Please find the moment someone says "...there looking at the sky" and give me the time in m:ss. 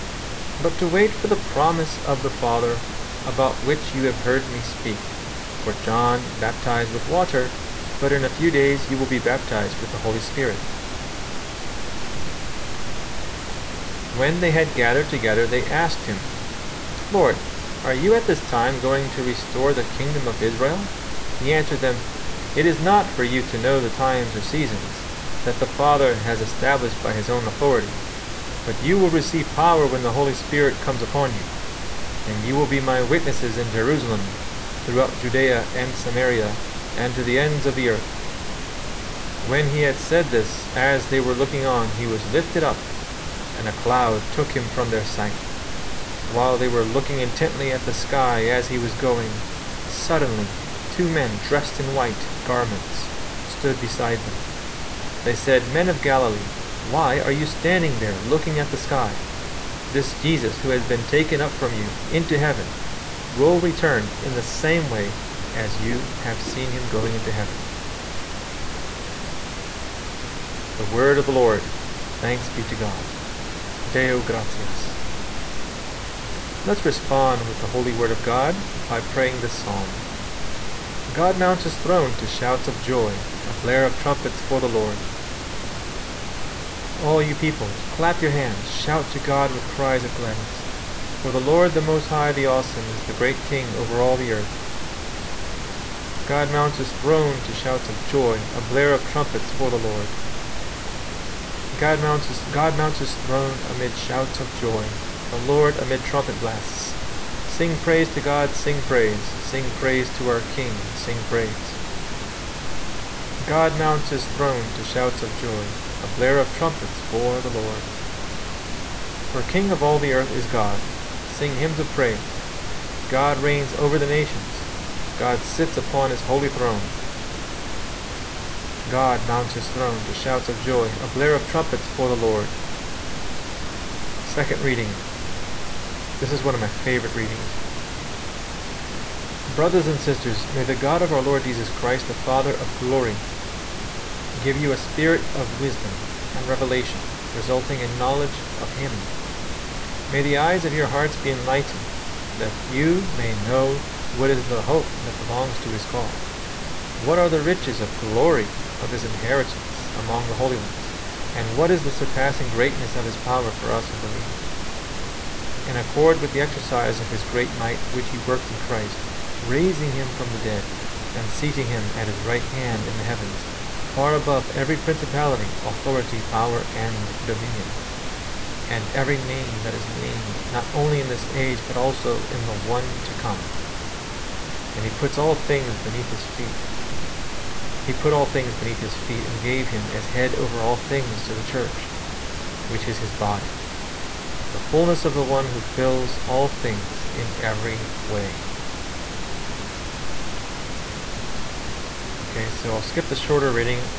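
0:57.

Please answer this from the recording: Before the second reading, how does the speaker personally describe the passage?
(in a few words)
one of my favorite readings.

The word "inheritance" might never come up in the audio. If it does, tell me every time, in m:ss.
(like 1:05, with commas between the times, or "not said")
2:39.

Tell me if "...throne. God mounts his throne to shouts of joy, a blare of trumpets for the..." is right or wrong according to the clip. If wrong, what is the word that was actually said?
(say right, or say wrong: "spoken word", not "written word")
right.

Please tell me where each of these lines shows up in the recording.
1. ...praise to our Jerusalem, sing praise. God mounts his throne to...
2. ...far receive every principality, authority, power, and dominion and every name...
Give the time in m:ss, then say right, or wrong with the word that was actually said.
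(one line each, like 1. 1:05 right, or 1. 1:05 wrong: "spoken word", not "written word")
1. 1:49 wrong: "King", not "Jerusalem"
2. 2:53 wrong: "above", not "receive".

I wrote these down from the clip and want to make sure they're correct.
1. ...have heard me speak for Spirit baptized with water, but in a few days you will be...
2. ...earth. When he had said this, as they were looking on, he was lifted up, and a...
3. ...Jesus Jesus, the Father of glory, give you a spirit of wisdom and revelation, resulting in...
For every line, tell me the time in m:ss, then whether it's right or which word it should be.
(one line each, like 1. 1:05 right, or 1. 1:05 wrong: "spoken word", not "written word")
1. 0:04 wrong: "John", not "Spirit"
2. 0:37 right
3. 2:21 wrong: "Christ", not "Jesus".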